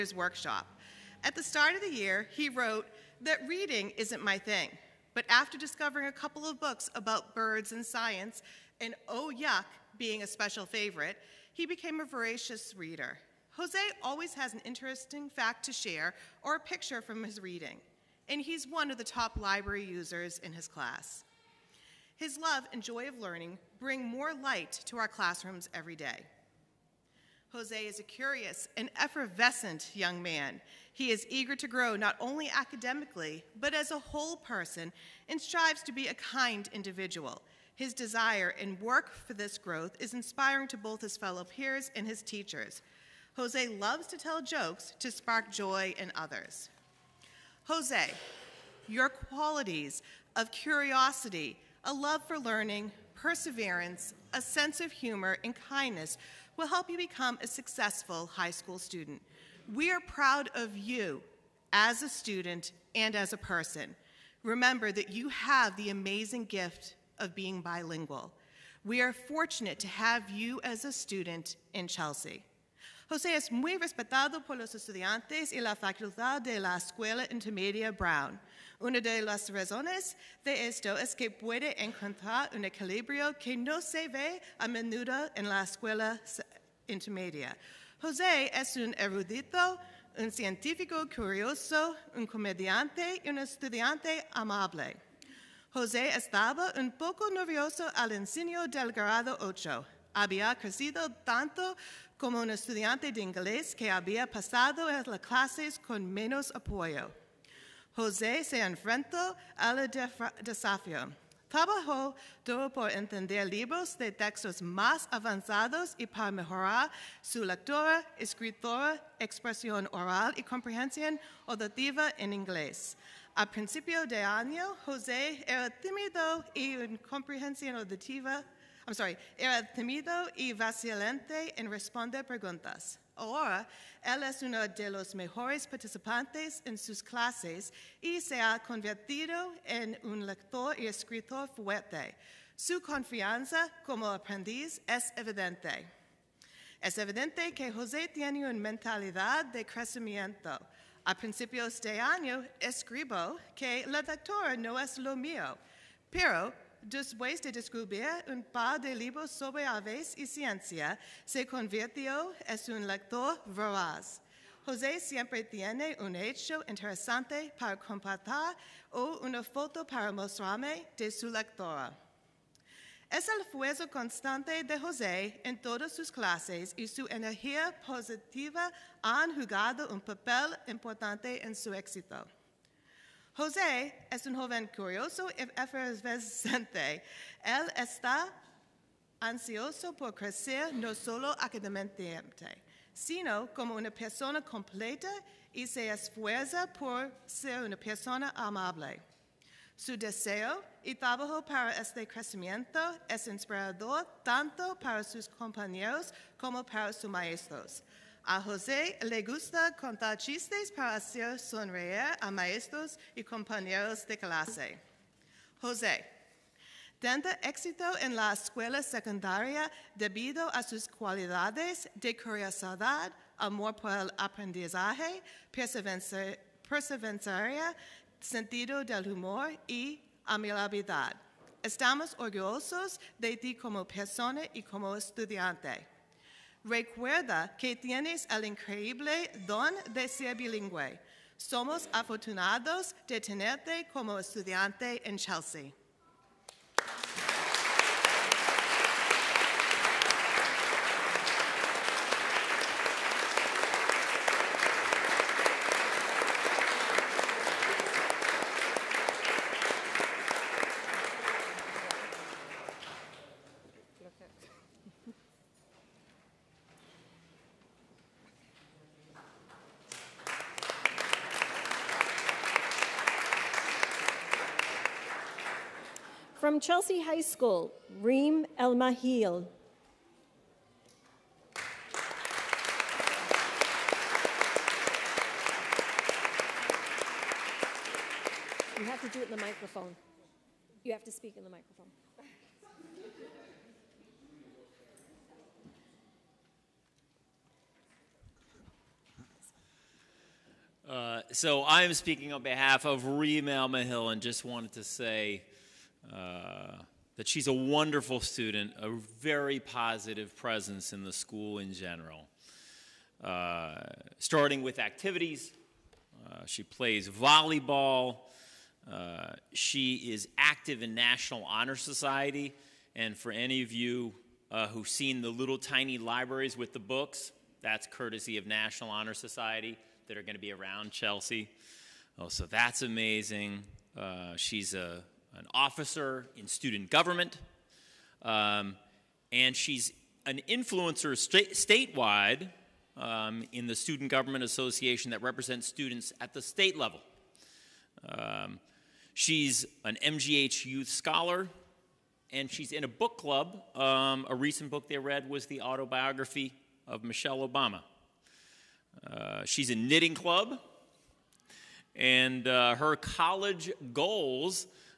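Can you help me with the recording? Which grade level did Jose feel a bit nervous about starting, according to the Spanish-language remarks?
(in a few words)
Grade 8.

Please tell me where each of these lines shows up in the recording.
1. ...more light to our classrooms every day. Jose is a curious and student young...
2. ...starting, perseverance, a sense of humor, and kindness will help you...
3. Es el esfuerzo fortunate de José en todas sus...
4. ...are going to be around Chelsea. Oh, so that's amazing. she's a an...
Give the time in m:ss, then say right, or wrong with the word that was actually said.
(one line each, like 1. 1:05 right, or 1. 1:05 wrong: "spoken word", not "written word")
1. 0:24 wrong: "effervescent", not "student"
2. 0:52 wrong: "learning", not "starting"
3. 2:53 wrong: "constante", not "fortunate"
4. 5:30 right.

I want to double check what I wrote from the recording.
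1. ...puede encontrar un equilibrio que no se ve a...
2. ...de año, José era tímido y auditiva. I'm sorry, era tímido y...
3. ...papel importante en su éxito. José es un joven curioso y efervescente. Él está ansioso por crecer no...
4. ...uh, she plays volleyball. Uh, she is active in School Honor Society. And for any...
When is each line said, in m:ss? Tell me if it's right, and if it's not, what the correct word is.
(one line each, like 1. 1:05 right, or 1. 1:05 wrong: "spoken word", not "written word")
1. 1:21 right
2. 2:04 right
3. 2:59 right
4. 5:16 wrong: "National", not "School".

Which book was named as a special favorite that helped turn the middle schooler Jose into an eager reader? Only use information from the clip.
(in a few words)
Oh Yuck.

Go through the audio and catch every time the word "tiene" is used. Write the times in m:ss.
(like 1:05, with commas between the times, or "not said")
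2:28, 2:45, 3:57.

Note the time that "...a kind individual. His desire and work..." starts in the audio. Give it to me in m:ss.
0:36.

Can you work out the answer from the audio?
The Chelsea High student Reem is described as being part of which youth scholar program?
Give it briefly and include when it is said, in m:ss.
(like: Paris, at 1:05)
MGH Youth Scholar, at 5:50.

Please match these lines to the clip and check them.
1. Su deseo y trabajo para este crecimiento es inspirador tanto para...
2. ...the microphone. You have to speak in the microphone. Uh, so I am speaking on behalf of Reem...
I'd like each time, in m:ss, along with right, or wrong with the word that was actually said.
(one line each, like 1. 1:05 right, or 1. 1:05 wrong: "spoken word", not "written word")
1. 3:19 right
2. 4:49 right.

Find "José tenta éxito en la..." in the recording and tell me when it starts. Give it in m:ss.
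3:35.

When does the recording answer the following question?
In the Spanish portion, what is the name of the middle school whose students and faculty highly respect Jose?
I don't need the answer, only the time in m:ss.
1:16.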